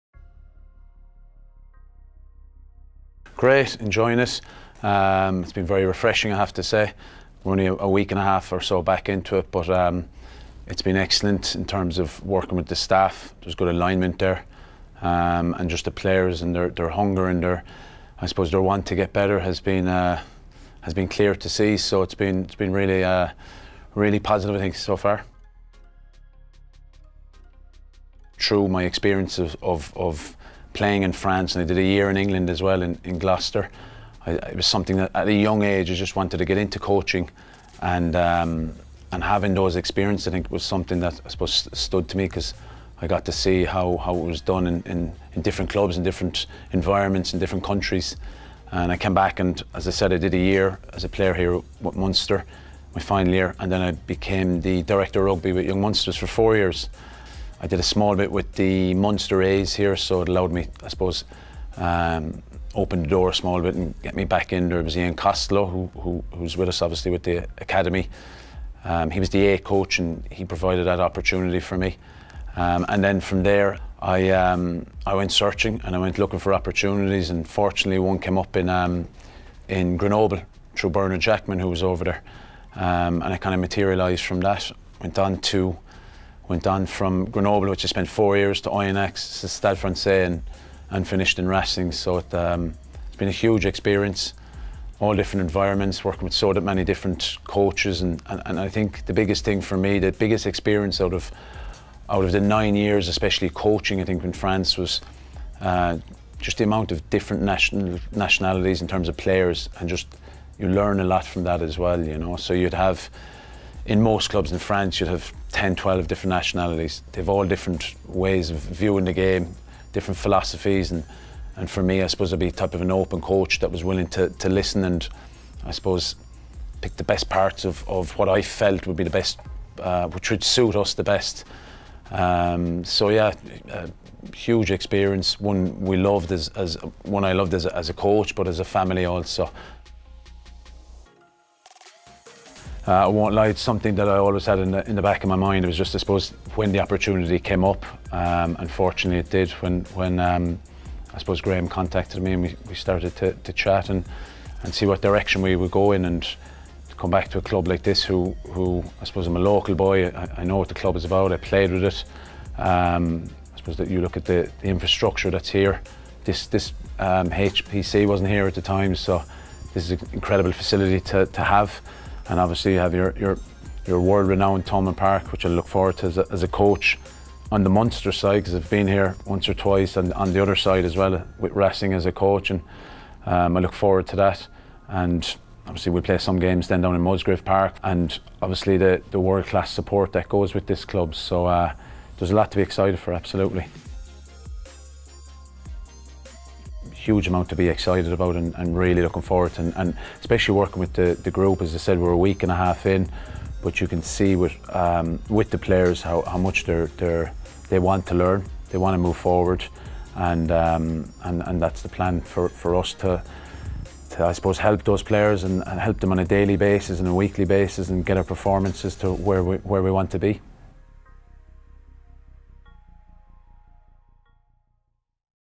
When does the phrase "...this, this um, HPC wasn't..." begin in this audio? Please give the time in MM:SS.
02:46.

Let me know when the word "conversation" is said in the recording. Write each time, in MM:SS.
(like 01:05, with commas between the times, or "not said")
not said.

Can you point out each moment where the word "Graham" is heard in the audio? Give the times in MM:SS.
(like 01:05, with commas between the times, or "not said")
02:31.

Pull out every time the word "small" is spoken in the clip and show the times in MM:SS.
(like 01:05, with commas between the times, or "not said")
00:57, 01:03.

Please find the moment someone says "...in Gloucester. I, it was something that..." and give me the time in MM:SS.
00:33.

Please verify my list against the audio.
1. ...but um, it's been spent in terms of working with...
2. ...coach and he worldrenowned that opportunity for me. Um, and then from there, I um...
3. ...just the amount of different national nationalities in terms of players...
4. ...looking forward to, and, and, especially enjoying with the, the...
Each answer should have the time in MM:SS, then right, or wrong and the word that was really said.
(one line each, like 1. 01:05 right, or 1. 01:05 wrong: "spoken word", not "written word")
1. 00:09 wrong: "excellent", not "spent"
2. 01:09 wrong: "provided", not "worldrenowned"
3. 01:46 right
4. 03:19 wrong: "working", not "enjoying".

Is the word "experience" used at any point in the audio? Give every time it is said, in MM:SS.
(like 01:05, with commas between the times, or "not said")
00:28, 00:39, 01:33, 01:40, 02:14.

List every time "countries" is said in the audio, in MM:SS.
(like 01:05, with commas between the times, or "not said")
00:47.